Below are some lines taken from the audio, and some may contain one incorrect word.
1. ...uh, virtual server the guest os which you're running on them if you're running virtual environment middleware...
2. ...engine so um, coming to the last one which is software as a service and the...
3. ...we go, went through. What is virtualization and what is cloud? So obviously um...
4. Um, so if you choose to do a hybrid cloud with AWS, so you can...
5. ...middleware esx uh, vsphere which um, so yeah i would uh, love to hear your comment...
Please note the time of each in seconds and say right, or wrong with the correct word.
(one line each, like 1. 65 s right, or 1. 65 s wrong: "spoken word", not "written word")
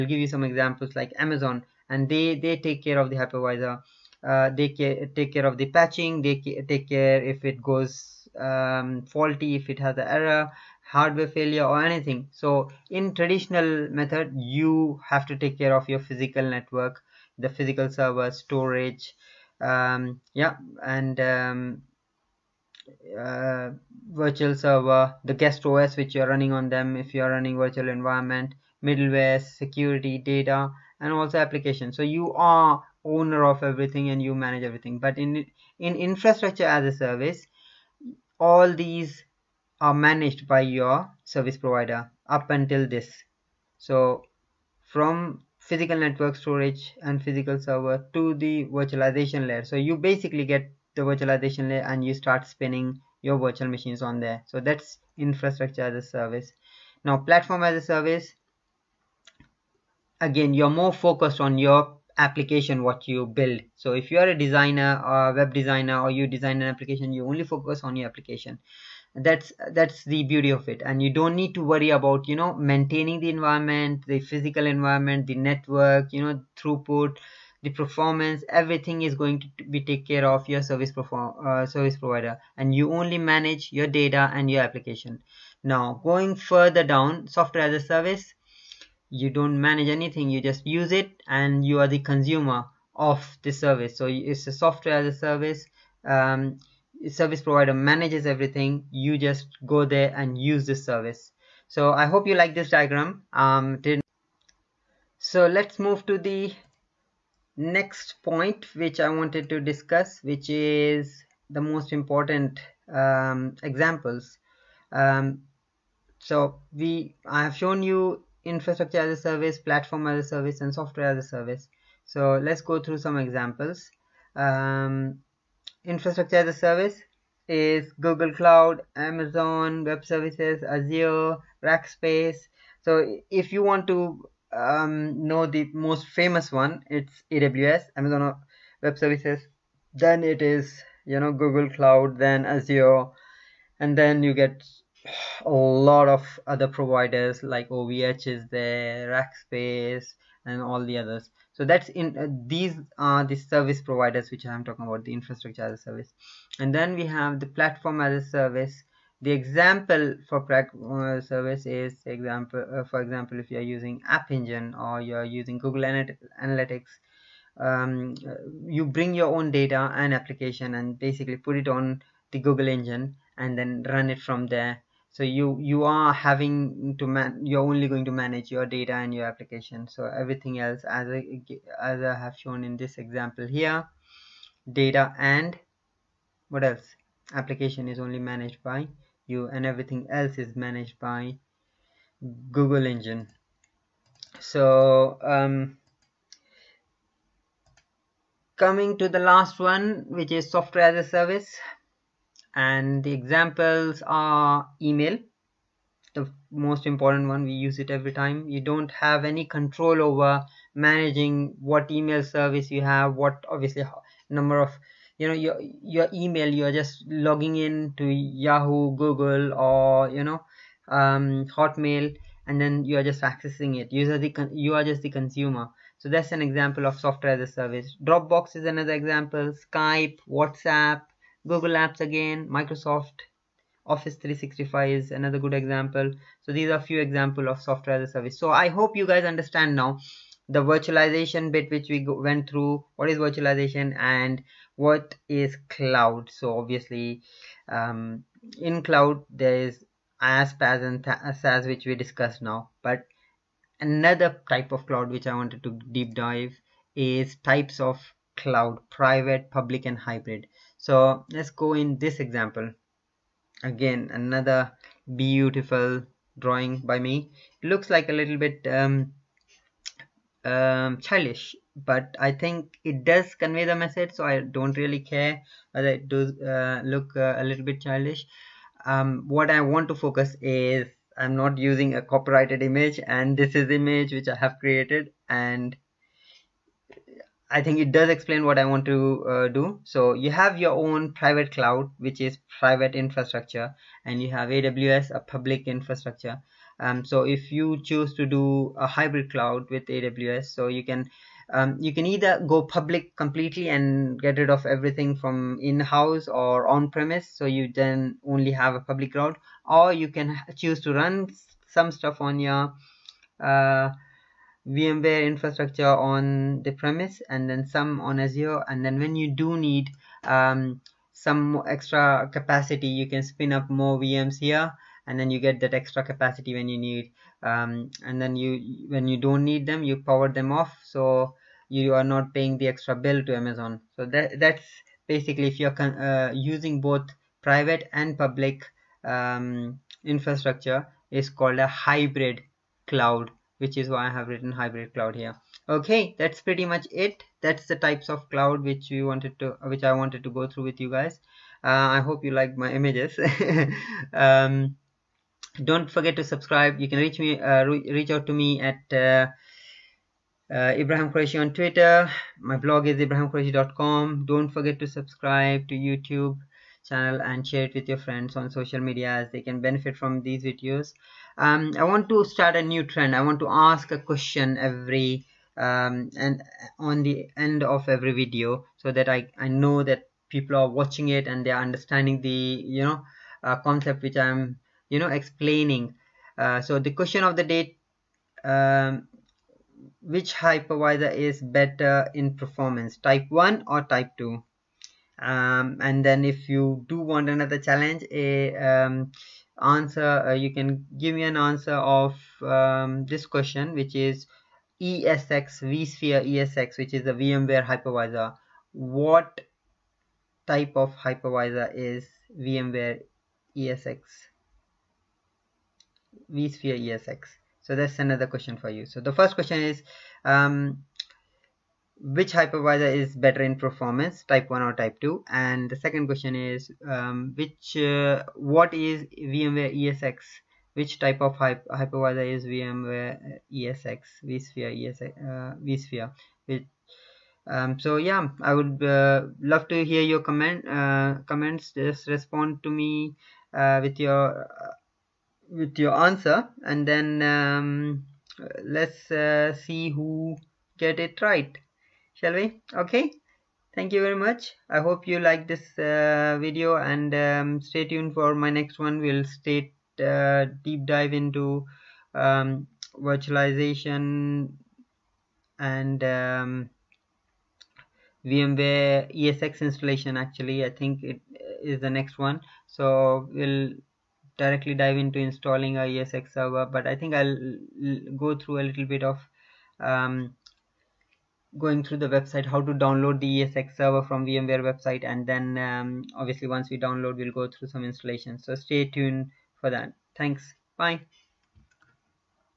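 1. 23 s right
2. 192 s right
3. 241 s right
4. 296 s right
5. 434 s wrong: "vsphere", not "middleware".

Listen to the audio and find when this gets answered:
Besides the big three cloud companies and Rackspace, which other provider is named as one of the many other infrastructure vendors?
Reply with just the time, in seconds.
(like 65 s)
147 s.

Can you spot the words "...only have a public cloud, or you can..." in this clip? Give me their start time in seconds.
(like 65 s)
308 s.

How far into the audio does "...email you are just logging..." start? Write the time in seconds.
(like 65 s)
216 s.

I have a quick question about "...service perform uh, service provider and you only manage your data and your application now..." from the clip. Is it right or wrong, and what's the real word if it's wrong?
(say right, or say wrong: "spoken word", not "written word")
right.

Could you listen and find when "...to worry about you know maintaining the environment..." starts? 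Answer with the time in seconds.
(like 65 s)
71 s.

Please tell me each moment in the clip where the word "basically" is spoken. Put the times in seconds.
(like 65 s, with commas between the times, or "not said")
49 s, 170 s, 335 s.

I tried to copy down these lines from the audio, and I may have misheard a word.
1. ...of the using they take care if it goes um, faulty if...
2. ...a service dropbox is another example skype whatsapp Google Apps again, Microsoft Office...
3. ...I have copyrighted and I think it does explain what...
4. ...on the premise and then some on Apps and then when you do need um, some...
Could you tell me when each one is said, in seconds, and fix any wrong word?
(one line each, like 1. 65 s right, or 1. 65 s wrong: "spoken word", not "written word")
1. 5 s wrong: "patching", not "using"
2. 227 s right
3. 284 s wrong: "created", not "copyrighted"
4. 315 s wrong: "Azure", not "Apps".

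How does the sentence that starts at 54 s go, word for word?
So that's infrastructure as a service.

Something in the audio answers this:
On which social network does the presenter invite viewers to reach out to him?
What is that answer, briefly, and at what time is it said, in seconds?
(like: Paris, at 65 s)
Twitter, at 361 s.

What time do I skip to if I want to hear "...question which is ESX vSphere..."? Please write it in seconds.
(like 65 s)
403 s.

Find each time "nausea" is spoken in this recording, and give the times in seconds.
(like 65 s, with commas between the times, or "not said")
not said.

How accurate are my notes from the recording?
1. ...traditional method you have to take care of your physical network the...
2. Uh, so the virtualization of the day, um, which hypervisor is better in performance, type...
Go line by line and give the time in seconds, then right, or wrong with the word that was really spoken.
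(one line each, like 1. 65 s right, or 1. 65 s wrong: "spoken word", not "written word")
1. 13 s right
2. 386 s wrong: "question", not "virtualization".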